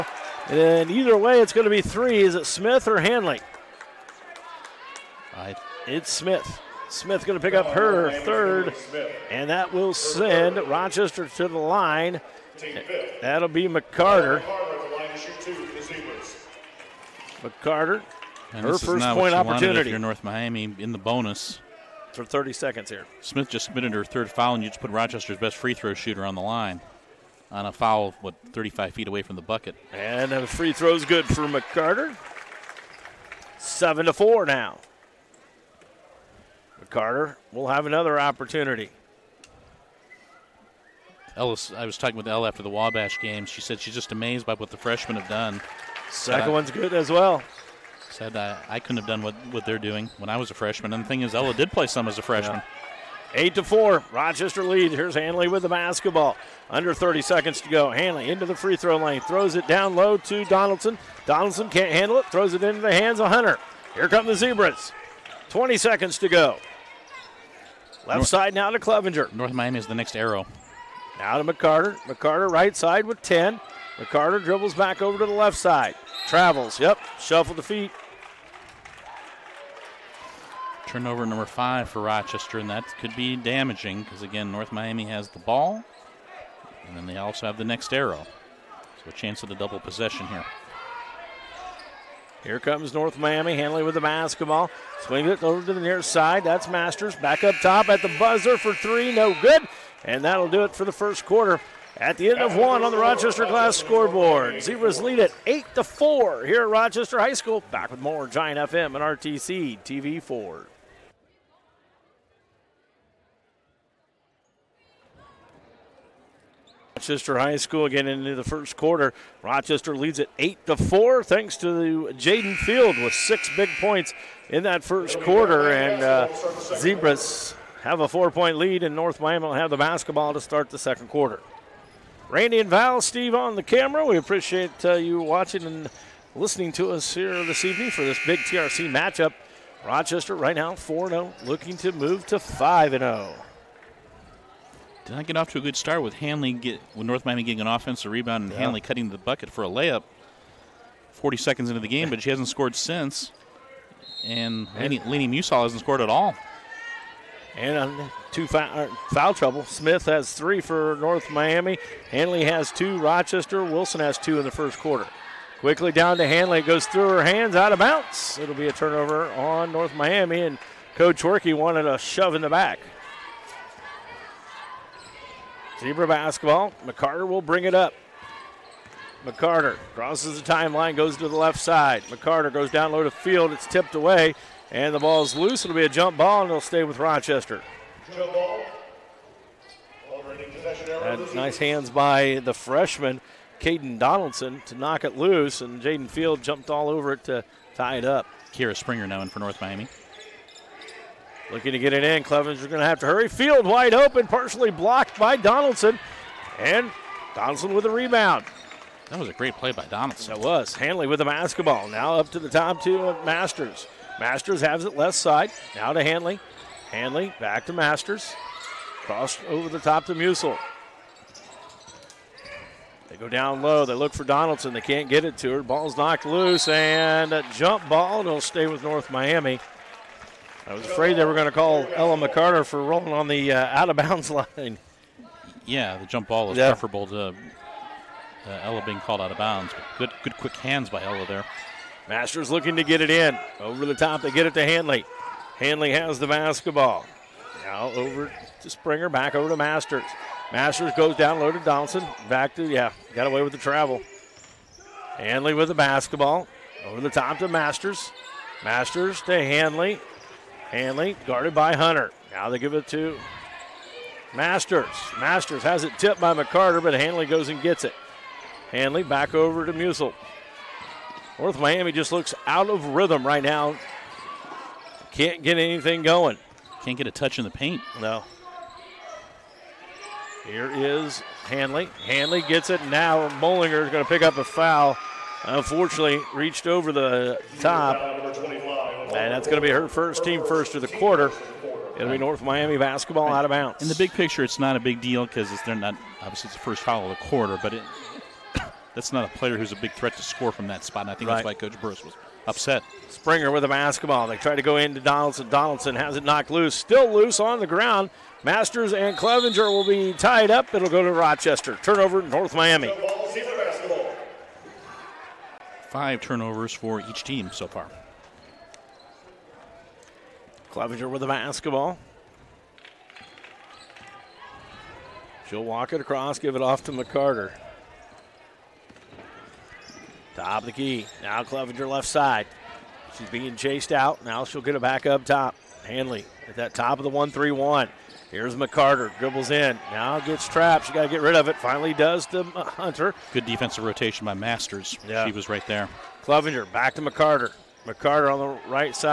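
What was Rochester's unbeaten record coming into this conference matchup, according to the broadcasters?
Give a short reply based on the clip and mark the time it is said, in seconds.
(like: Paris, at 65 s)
4-0, at 140 s.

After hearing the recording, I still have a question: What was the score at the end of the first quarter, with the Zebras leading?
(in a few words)
8 to 4.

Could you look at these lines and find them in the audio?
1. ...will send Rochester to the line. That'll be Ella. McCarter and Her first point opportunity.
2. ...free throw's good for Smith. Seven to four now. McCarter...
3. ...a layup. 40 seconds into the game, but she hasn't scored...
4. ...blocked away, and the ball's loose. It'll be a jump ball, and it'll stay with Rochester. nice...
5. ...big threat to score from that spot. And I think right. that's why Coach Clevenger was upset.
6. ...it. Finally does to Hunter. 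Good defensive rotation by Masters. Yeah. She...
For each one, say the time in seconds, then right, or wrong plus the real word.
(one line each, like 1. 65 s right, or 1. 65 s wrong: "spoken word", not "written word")
1. 9 s wrong: "McCarter", not "Ella"
2. 30 s wrong: "McCarter", not "Smith"
3. 149 s right
4. 183 s wrong: "tipped", not "blocked"
5. 299 s wrong: "Burris", not "Clevenger"
6. 341 s right.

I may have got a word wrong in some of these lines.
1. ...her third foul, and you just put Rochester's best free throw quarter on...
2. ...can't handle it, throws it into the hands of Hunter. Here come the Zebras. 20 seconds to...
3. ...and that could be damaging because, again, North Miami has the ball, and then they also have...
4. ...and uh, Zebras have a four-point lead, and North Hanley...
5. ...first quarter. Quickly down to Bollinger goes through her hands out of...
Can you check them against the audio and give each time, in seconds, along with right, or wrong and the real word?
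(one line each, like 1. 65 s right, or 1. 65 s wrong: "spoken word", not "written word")
1. 23 s wrong: "shooter", not "quarter"
2. 61 s right
3. 82 s right
4. 125 s wrong: "Miami", not "Hanley"
5. 164 s wrong: "Hanley", not "Bollinger".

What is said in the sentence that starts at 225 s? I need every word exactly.
Ball's knocked loose and a jump ball.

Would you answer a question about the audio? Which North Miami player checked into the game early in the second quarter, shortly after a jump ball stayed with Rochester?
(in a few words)
Kira Springer.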